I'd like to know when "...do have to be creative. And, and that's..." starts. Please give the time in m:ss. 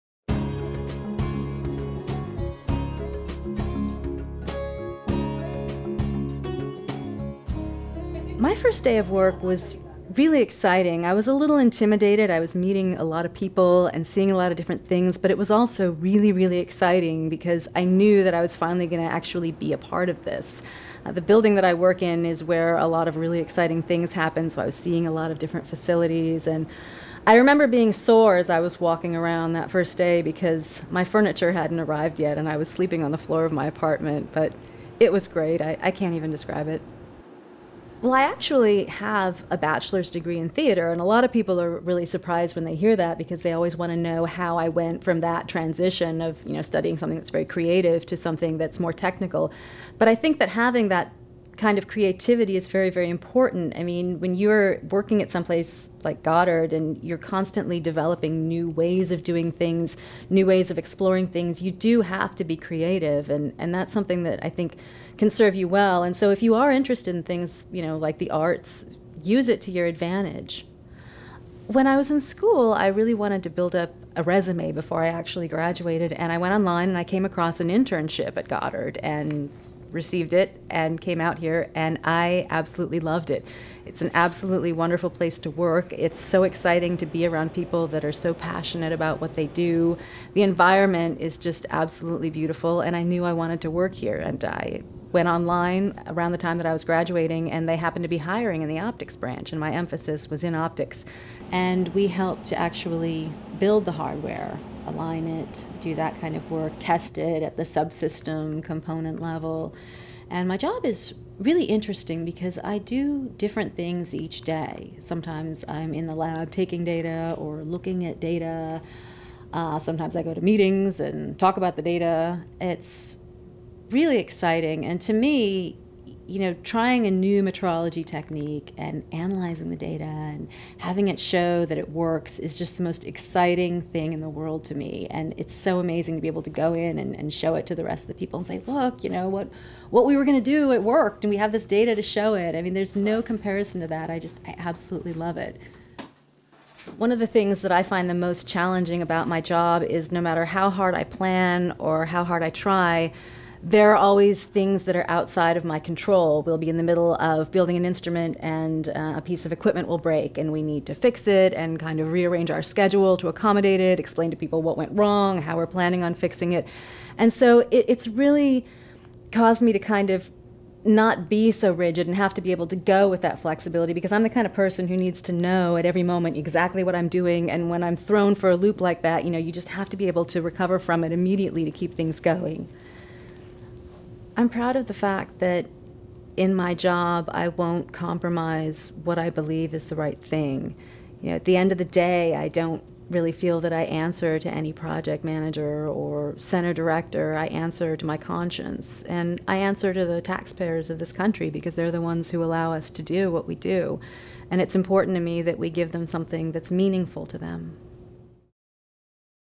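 1:01.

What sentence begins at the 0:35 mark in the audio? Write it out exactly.
I, I can't even describe it.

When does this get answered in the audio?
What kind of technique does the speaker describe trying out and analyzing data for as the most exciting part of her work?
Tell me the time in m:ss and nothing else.
2:07.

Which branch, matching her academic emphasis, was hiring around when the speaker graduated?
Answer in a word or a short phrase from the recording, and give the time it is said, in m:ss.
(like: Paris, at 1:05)
Optics branch, at 1:38.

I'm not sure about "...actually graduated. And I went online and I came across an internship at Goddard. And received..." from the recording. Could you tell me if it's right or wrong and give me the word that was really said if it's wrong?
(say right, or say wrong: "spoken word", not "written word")
right.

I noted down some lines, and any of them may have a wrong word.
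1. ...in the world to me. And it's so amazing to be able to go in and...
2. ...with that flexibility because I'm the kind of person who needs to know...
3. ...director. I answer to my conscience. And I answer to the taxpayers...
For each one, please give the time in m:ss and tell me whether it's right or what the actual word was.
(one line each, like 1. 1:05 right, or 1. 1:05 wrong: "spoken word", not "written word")
1. 2:14 right
2. 2:53 right
3. 3:16 right.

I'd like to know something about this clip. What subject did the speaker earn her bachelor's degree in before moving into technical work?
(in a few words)
Theater.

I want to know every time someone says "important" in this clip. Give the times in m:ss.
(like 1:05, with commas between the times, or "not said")
0:53, 3:24.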